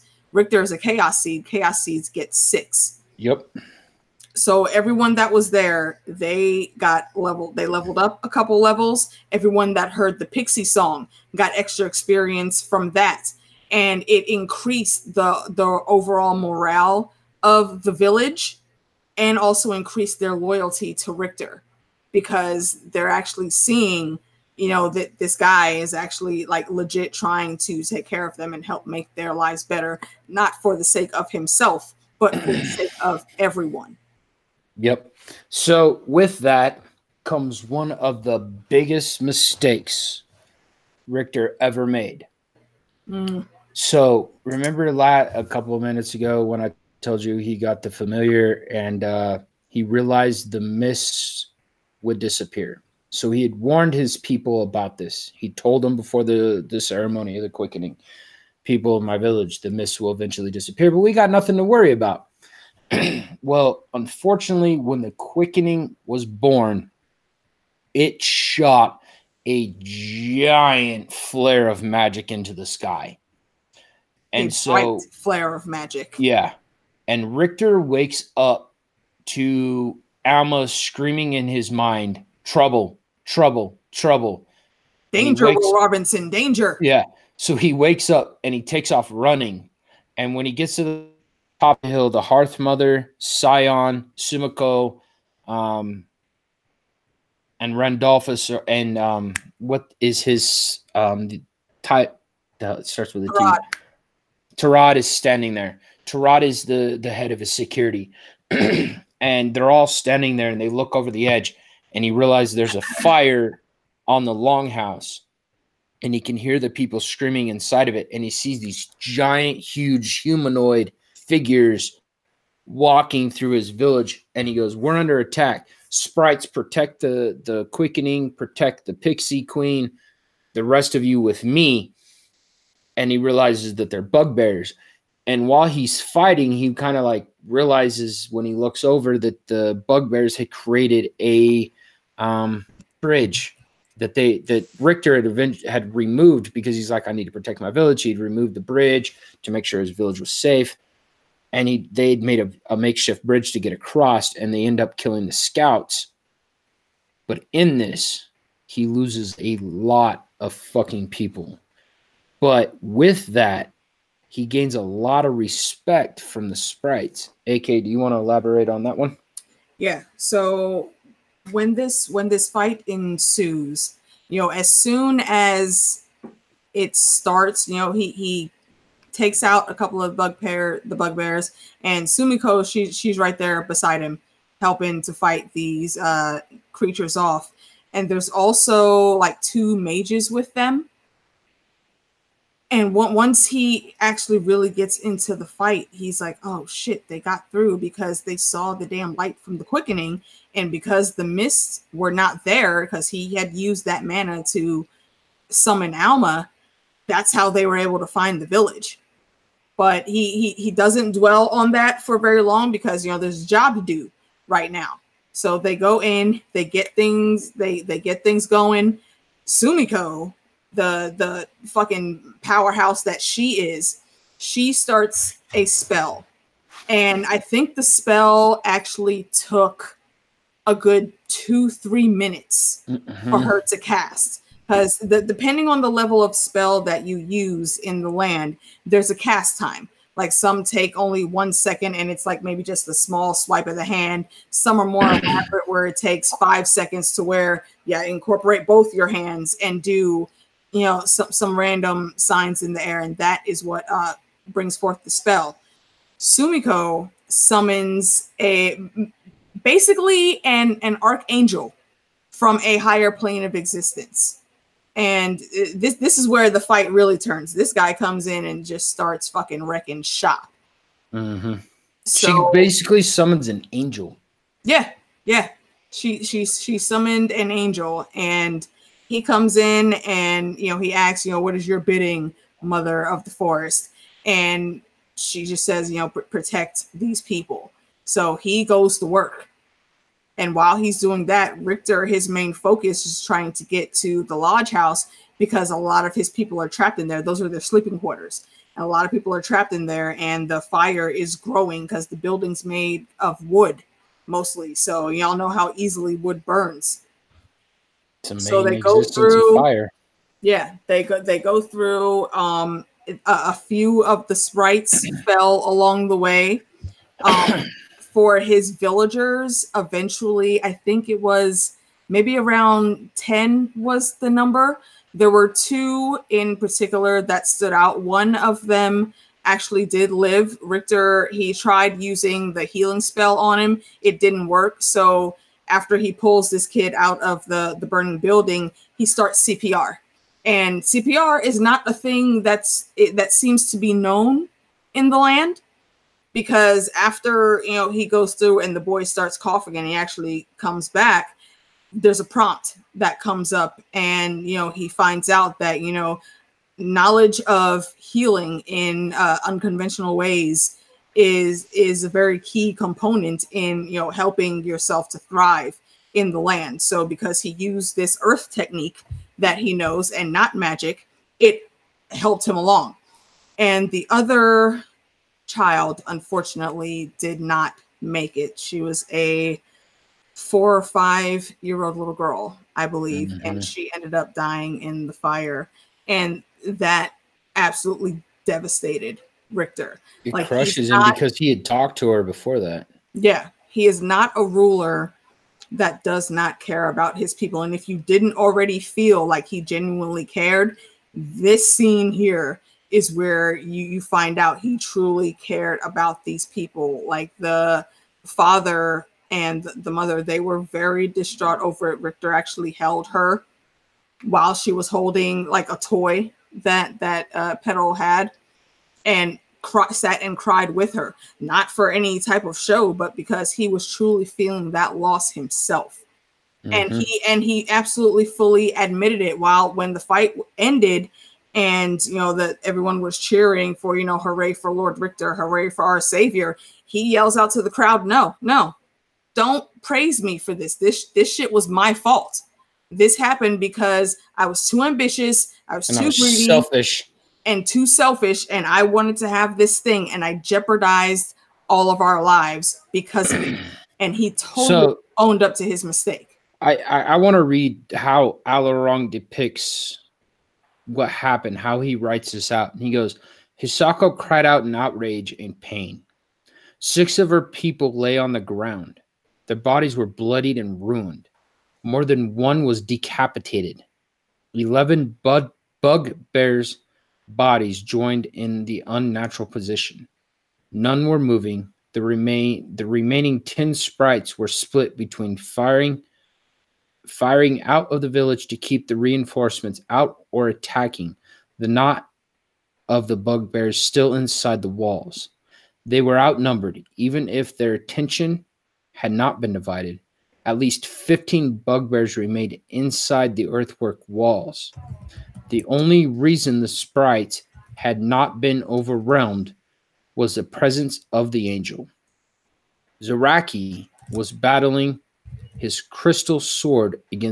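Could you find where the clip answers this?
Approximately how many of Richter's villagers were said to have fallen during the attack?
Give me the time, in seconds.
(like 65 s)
323 s.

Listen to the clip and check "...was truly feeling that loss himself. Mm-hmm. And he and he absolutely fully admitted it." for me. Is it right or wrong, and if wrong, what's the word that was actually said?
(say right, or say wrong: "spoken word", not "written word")
right.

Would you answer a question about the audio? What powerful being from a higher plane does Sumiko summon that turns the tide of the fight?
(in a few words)
An archangel.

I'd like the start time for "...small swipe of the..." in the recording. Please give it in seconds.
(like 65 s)
242 s.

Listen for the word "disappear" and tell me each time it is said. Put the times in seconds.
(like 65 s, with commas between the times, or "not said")
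52 s, 60 s.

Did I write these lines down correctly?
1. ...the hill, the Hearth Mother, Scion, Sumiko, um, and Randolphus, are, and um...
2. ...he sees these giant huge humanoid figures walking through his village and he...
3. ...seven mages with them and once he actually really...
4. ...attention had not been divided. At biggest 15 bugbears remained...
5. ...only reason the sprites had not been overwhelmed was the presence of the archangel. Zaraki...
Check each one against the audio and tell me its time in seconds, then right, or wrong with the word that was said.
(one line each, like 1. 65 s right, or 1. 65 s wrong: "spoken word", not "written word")
1. 91 s right
2. 118 s right
3. 189 s wrong: "two", not "seven"
4. 497 s wrong: "least", not "biggest"
5. 505 s wrong: "angel", not "archangel".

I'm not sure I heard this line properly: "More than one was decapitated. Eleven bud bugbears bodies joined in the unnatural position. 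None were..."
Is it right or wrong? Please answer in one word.
right.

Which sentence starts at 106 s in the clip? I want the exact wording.
Tarad is the, the head of his security.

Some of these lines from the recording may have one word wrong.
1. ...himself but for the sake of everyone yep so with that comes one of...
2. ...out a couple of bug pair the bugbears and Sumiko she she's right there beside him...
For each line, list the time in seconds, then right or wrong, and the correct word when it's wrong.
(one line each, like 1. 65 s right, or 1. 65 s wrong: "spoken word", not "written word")
1. 31 s right
2. 179 s right.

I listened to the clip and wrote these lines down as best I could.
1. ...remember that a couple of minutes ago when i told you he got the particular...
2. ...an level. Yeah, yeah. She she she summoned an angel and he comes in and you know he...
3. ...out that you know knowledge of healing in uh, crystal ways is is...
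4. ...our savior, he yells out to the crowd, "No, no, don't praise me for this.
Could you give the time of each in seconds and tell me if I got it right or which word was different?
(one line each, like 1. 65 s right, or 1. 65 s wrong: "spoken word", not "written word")
1. 44 s wrong: "familiar", not "particular"
2. 273 s wrong: "angel", not "level"
3. 355 s wrong: "unconventional", not "crystal"
4. 435 s right.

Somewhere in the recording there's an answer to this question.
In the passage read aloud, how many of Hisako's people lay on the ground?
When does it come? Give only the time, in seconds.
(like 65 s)
466 s.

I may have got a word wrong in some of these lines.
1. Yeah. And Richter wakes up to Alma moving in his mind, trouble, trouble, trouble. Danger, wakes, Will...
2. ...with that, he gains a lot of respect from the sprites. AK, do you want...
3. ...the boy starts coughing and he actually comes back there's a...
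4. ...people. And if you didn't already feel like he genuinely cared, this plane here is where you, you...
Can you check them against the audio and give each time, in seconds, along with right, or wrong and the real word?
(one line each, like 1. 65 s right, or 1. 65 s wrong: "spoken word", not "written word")
1. 76 s wrong: "screaming", not "moving"
2. 162 s right
3. 348 s right
4. 397 s wrong: "scene", not "plane".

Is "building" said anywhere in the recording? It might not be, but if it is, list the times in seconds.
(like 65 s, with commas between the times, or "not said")
302 s, 338 s.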